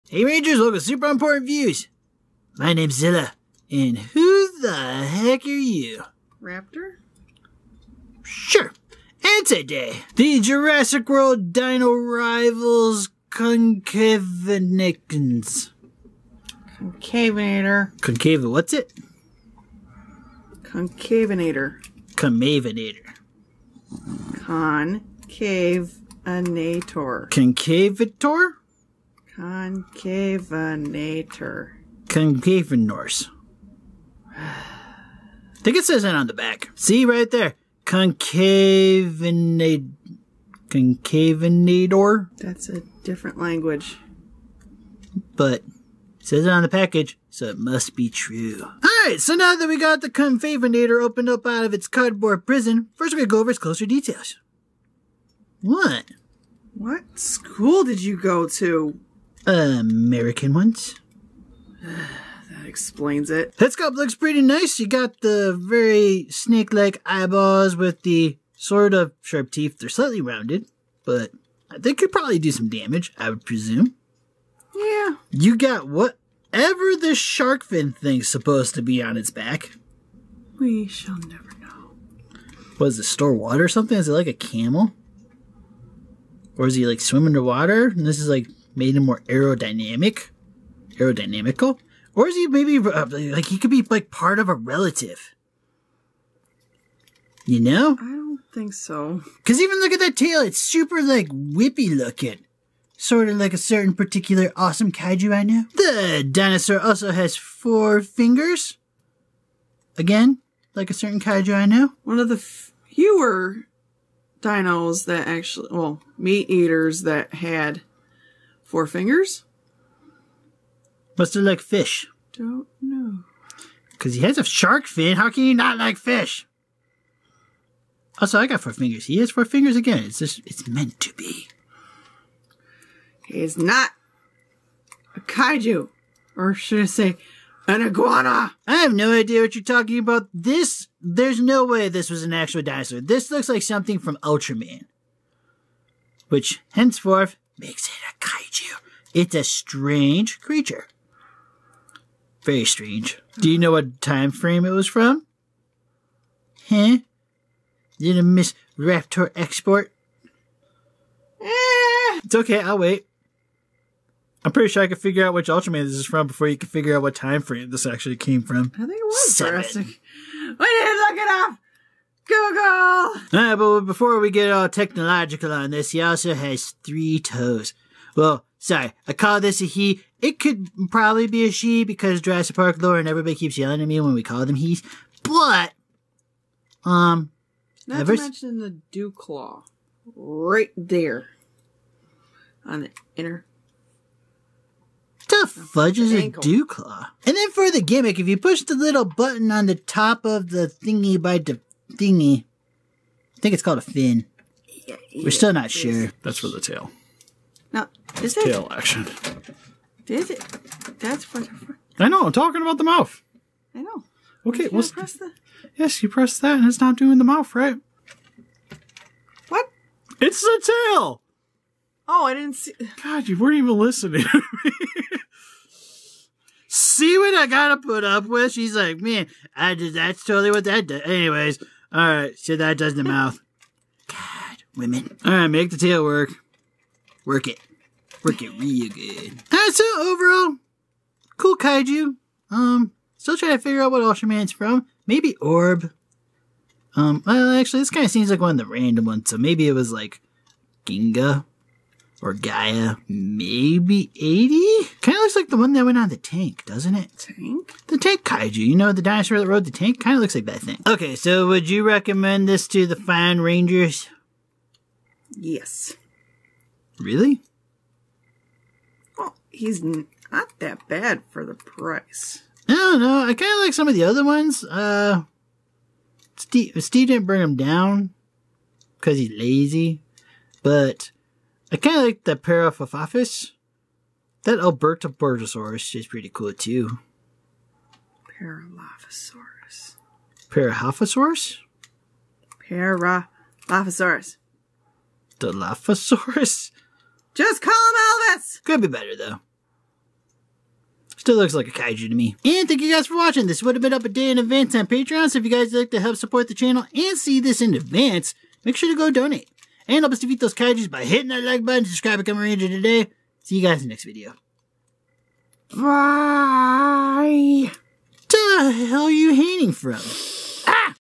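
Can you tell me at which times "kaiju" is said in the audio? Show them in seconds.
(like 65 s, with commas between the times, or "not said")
104 s, 111 s, 135 s, 148 s, 241 s, 258 s, 301 s, 310 s.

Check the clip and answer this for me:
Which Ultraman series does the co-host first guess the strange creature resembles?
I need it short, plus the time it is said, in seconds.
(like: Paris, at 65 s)
Seven, at 169 s.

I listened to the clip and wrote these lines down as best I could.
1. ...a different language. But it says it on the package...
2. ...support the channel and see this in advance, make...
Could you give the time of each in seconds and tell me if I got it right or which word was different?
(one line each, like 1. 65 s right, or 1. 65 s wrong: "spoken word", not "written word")
1. 42 s right
2. 306 s right.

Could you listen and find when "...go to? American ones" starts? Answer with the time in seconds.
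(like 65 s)
58 s.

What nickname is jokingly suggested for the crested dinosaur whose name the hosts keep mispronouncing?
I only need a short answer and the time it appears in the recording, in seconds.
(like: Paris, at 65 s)
Elvis, at 298 s.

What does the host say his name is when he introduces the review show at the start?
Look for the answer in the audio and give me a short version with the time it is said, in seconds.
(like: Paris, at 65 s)
Zilla, at 2 s.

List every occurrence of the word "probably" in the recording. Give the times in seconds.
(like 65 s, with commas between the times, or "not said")
72 s, 180 s.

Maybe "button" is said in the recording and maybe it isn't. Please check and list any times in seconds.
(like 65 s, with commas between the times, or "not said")
199 s, 311 s.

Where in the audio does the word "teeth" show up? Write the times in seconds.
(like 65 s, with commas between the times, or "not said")
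69 s.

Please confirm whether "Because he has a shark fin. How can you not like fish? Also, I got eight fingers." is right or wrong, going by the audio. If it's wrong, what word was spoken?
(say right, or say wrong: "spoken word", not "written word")
wrong: "four", not "eight".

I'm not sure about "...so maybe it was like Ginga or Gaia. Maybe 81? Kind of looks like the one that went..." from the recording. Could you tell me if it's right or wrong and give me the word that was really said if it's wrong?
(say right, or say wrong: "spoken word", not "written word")
wrong: "80", not "81".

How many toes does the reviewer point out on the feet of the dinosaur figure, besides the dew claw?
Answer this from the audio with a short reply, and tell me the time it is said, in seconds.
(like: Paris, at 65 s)
3, at 176 s.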